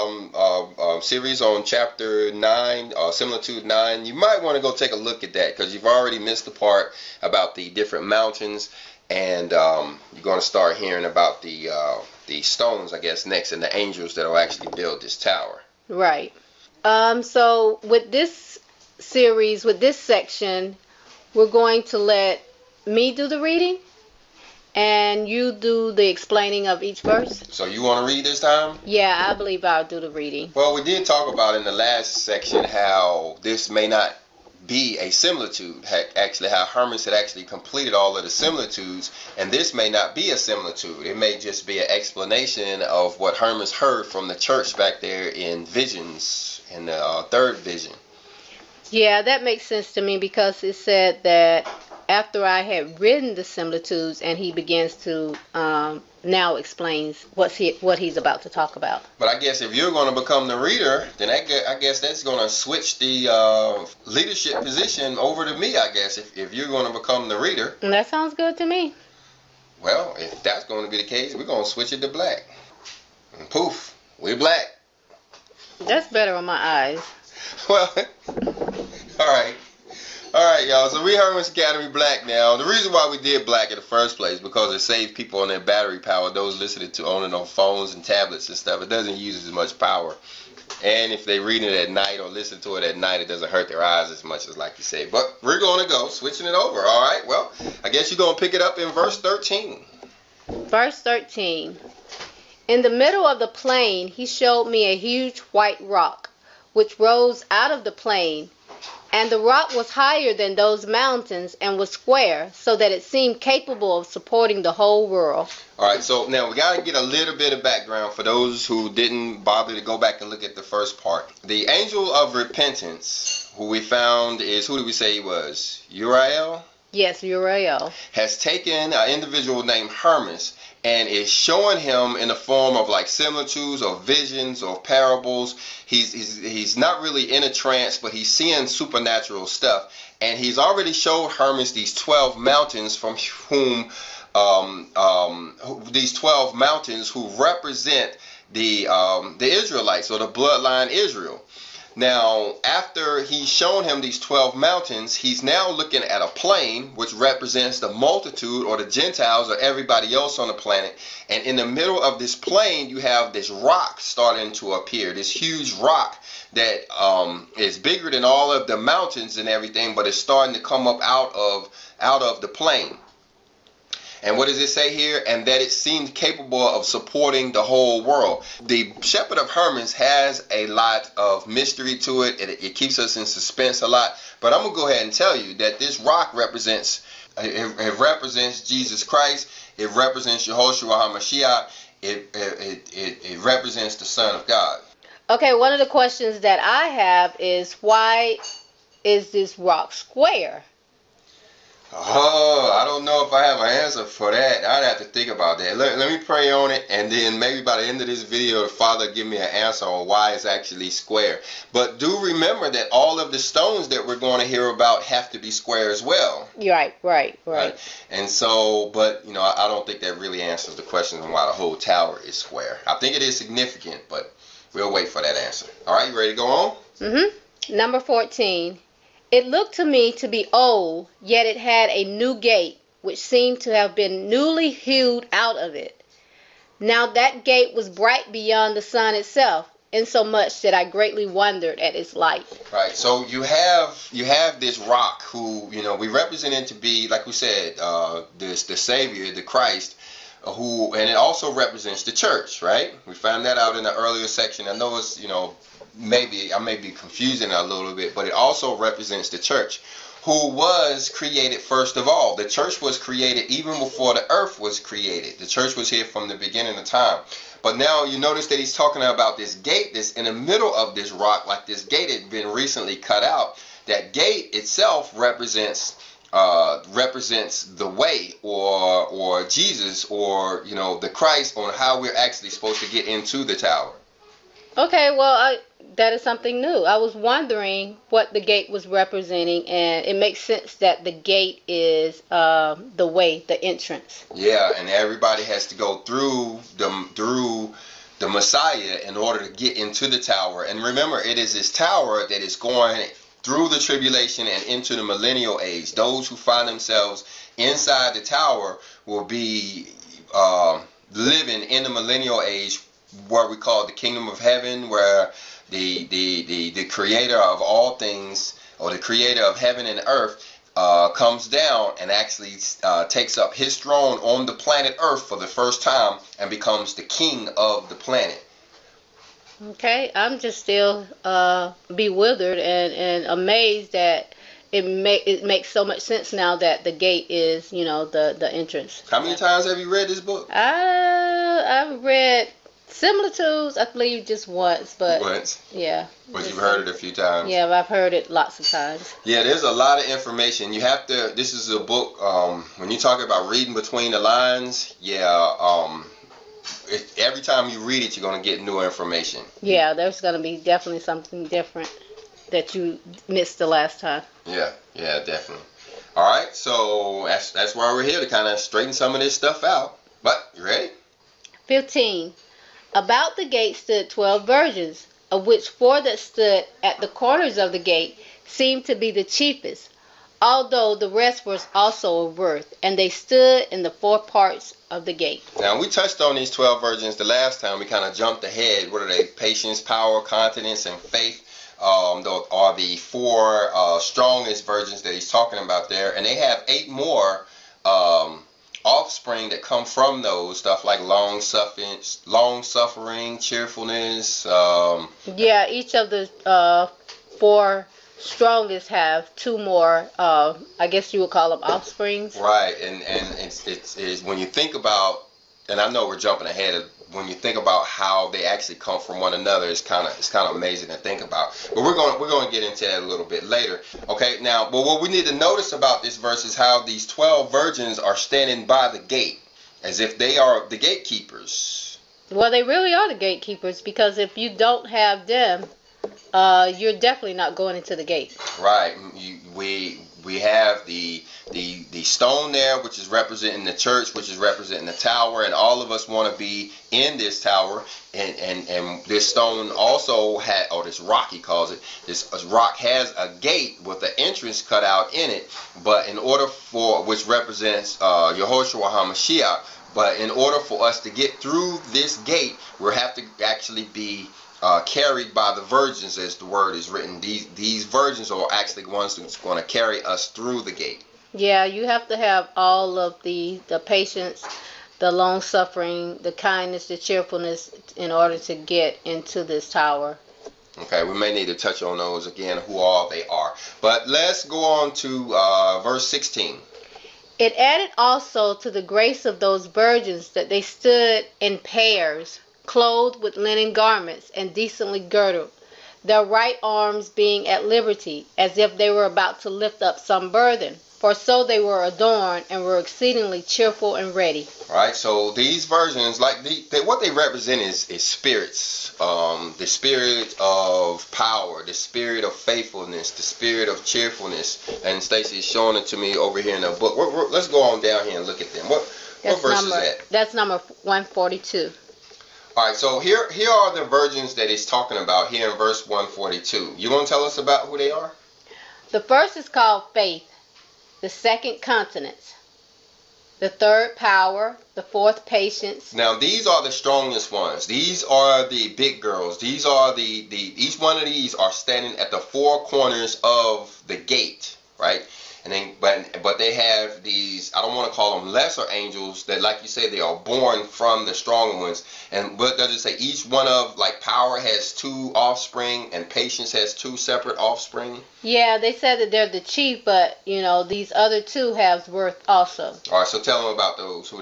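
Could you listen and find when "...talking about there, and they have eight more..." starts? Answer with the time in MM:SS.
06:35.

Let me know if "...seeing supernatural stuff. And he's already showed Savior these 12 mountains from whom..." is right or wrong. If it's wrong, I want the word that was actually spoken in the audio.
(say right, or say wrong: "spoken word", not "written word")
wrong: "Hermes", not "Savior".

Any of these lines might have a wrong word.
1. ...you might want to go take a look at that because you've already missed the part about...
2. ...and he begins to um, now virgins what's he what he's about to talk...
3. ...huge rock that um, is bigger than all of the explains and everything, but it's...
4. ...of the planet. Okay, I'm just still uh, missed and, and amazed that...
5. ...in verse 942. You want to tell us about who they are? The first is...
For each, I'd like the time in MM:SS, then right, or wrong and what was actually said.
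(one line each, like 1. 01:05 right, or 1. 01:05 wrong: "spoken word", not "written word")
1. 00:04 right
2. 00:54 wrong: "explains", not "virgins"
3. 02:45 wrong: "mountains", not "explains"
4. 05:27 wrong: "bewildered", not "missed"
5. 08:45 wrong: "142", not "942".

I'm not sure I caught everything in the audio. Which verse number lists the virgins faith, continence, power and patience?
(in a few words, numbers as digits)
142.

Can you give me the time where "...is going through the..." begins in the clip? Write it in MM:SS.
05:02.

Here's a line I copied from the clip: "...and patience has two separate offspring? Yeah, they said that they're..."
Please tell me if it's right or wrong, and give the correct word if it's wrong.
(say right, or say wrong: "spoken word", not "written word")
right.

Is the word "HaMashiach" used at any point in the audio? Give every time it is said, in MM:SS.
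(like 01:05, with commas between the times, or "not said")
03:10, 07:38.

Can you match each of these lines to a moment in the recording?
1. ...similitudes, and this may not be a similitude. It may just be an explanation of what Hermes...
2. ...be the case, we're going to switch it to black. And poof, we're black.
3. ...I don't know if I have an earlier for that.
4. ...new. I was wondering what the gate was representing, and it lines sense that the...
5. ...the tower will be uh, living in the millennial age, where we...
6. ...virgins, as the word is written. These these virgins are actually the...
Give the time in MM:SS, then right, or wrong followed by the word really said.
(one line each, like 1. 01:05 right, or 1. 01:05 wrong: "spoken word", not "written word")
1. 00:38 right
2. 01:10 right
3. 03:22 wrong: "answer", not "earlier"
4. 04:46 wrong: "makes", not "lines"
5. 05:08 right
6. 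07:45 right.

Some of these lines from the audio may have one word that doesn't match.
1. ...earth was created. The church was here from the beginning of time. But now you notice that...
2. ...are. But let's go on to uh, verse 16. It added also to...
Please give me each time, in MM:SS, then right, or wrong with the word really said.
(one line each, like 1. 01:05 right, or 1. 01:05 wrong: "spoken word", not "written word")
1. 04:24 right
2. 08:03 right.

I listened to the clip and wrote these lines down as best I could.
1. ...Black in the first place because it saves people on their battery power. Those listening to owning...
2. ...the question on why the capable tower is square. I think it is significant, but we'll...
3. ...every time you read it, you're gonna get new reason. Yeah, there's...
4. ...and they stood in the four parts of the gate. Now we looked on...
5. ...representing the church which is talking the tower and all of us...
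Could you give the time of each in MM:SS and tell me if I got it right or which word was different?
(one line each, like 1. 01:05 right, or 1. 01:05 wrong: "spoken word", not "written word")
1. 01:23 right
2. 03:40 wrong: "whole", not "capable"
3. 05:57 wrong: "information", not "reason"
4. 06:22 wrong: "touched", not "looked"
5. 07:23 wrong: "representing", not "talking".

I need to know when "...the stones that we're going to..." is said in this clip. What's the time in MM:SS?
03:33.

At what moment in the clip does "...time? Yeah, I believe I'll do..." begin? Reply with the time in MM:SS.
00:28.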